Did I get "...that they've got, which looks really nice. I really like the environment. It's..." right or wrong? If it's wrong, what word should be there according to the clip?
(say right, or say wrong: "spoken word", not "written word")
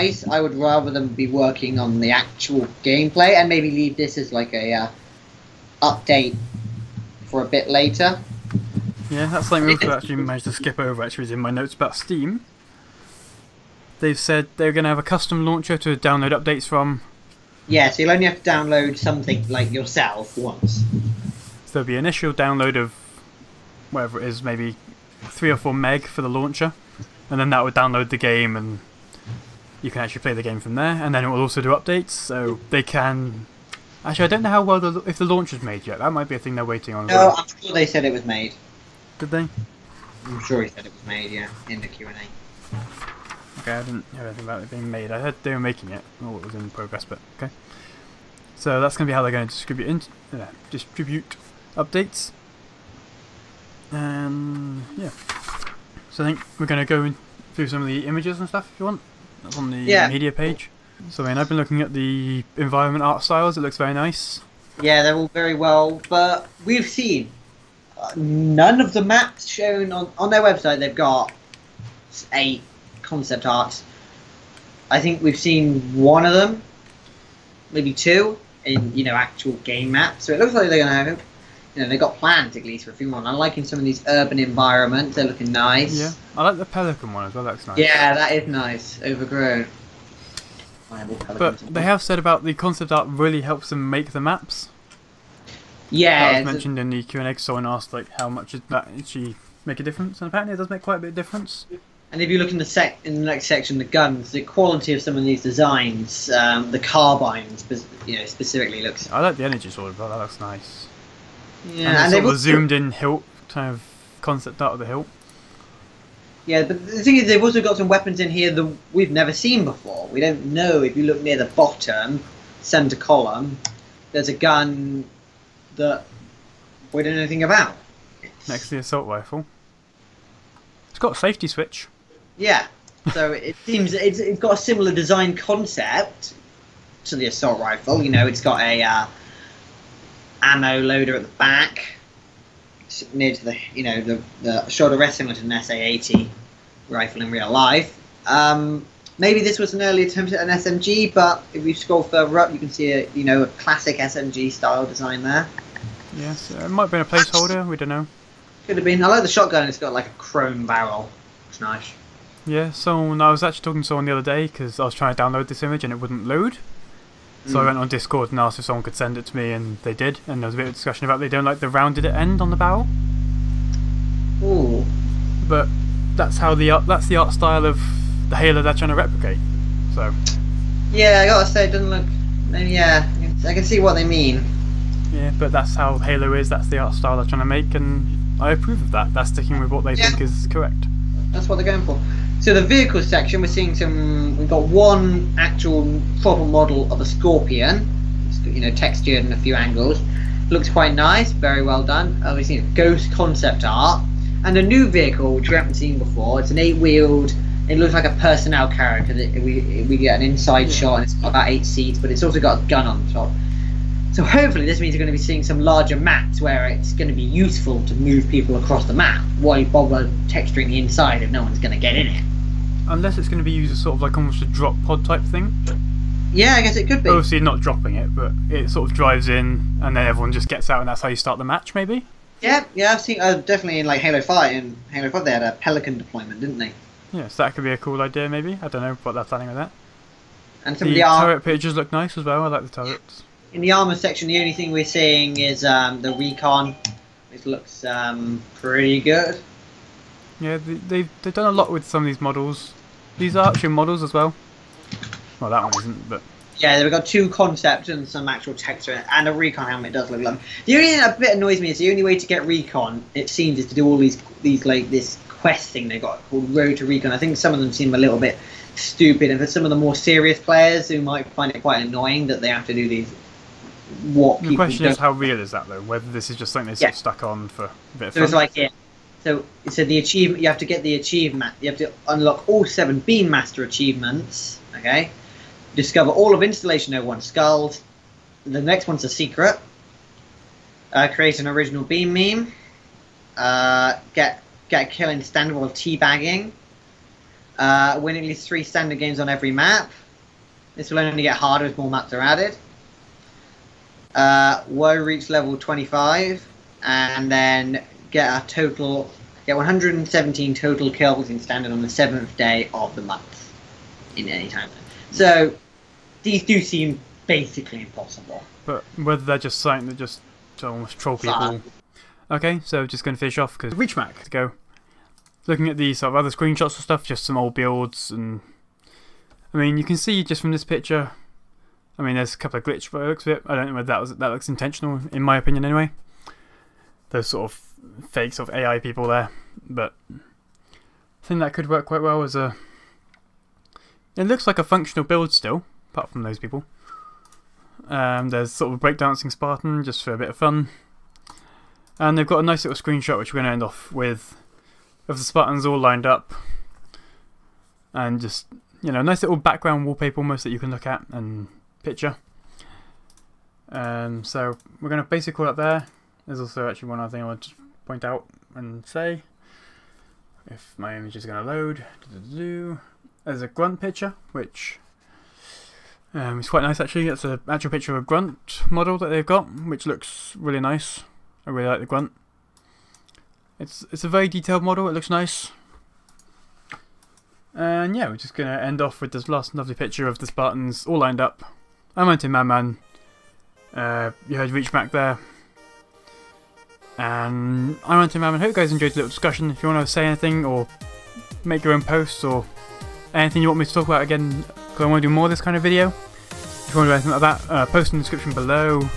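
wrong: "grunt", not "environment".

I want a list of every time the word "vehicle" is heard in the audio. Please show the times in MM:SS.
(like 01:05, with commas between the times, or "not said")
03:12, 03:24.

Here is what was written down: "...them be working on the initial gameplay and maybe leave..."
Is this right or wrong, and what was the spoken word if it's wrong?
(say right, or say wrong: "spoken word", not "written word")
wrong: "actual", not "initial".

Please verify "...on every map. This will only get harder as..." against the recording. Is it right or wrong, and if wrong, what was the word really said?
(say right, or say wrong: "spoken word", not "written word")
right.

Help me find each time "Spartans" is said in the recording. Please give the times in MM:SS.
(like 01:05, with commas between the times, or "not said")
05:49, 05:55, 06:30.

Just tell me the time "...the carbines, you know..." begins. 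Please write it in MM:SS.
01:46.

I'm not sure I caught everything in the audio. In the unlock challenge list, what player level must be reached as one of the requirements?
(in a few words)
25.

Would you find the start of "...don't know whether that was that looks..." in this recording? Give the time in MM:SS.
05:33.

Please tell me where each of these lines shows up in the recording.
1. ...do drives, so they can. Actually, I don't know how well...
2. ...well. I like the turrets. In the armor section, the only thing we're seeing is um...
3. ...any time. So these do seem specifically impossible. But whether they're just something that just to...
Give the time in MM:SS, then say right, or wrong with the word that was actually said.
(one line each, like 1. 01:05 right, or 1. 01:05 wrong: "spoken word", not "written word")
1. 00:31 wrong: "updates", not "drives"
2. 04:02 right
3. 05:14 wrong: "basically", not "specifically".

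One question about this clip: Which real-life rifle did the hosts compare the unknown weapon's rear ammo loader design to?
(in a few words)
SA-80.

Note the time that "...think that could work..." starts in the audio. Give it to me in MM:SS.
05:41.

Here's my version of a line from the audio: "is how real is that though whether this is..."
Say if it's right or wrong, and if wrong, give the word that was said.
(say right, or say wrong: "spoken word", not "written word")
right.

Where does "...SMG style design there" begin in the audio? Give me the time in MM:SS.
02:33.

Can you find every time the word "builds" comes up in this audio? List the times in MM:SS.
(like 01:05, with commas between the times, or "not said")
05:27, 05:45.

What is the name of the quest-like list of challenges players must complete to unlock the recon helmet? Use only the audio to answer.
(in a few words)
Road to Recon.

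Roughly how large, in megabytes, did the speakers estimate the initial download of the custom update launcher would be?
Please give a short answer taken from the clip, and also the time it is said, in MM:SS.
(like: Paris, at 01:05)
3 or 4 MB, at 00:25.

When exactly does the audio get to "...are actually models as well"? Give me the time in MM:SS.
04:13.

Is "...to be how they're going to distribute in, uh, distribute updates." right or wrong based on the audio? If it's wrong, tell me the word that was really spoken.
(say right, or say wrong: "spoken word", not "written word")
right.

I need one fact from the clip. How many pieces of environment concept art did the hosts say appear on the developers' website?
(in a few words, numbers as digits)
8.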